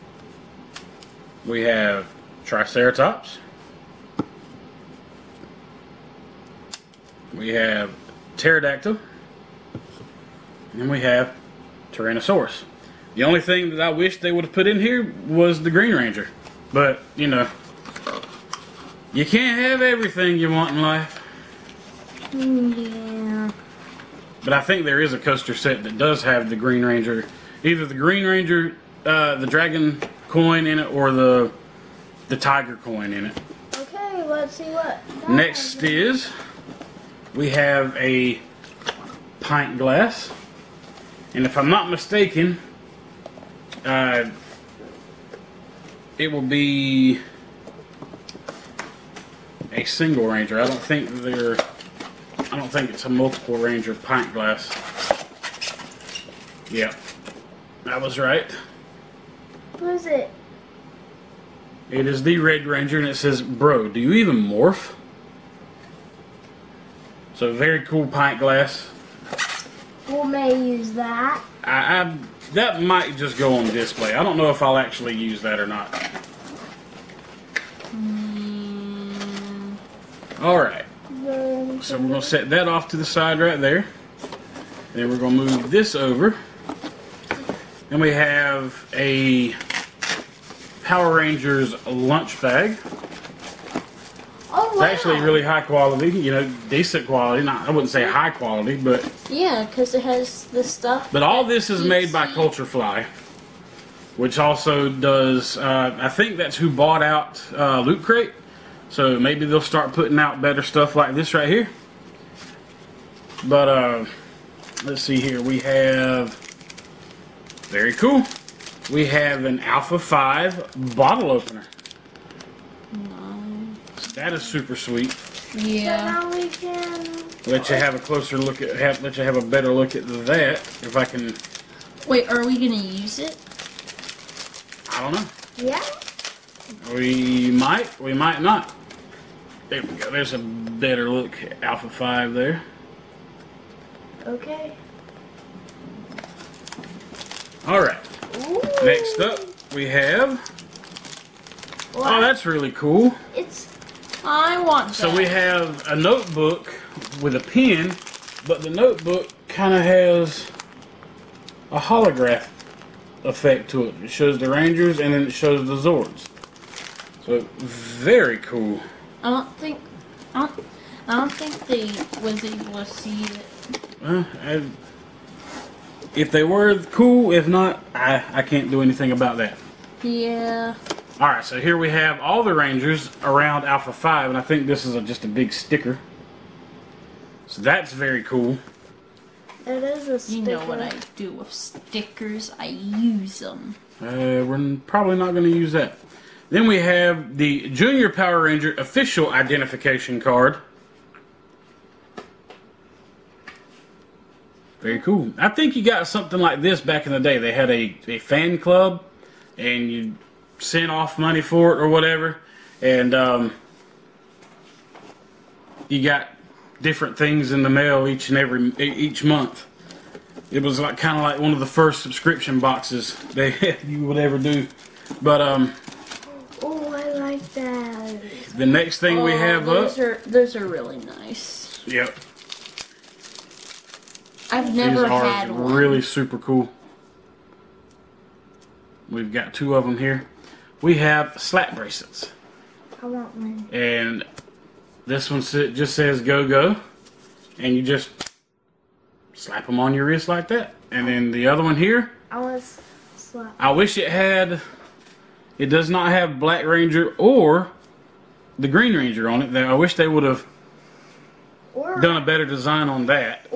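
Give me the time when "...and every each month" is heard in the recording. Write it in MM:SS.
03:38.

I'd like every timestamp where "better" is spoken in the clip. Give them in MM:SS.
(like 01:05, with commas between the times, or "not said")
01:50, 02:09, 02:20, 04:22.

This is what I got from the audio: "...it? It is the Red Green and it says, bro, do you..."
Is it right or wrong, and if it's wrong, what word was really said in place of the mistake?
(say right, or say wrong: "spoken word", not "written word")
wrong: "Ranger", not "Green".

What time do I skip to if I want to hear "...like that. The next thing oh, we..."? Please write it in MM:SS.
03:47.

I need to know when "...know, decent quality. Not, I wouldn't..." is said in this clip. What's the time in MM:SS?
01:36.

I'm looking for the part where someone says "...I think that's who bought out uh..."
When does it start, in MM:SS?
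01:45.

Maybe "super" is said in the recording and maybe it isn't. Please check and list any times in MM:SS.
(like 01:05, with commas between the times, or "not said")
02:04, 03:56.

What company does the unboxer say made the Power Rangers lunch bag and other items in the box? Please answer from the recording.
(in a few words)
CultureFly.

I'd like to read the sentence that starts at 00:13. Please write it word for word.
The only thing that I wish they would have put in here was the Green Ranger.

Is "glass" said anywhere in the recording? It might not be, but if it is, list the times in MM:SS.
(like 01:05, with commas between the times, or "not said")
00:39, 00:54, 01:08.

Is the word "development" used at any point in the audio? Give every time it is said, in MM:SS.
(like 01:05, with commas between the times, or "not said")
not said.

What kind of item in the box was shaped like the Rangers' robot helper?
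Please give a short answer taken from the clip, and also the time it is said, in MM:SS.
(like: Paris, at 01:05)
bottle opener, at 02:00.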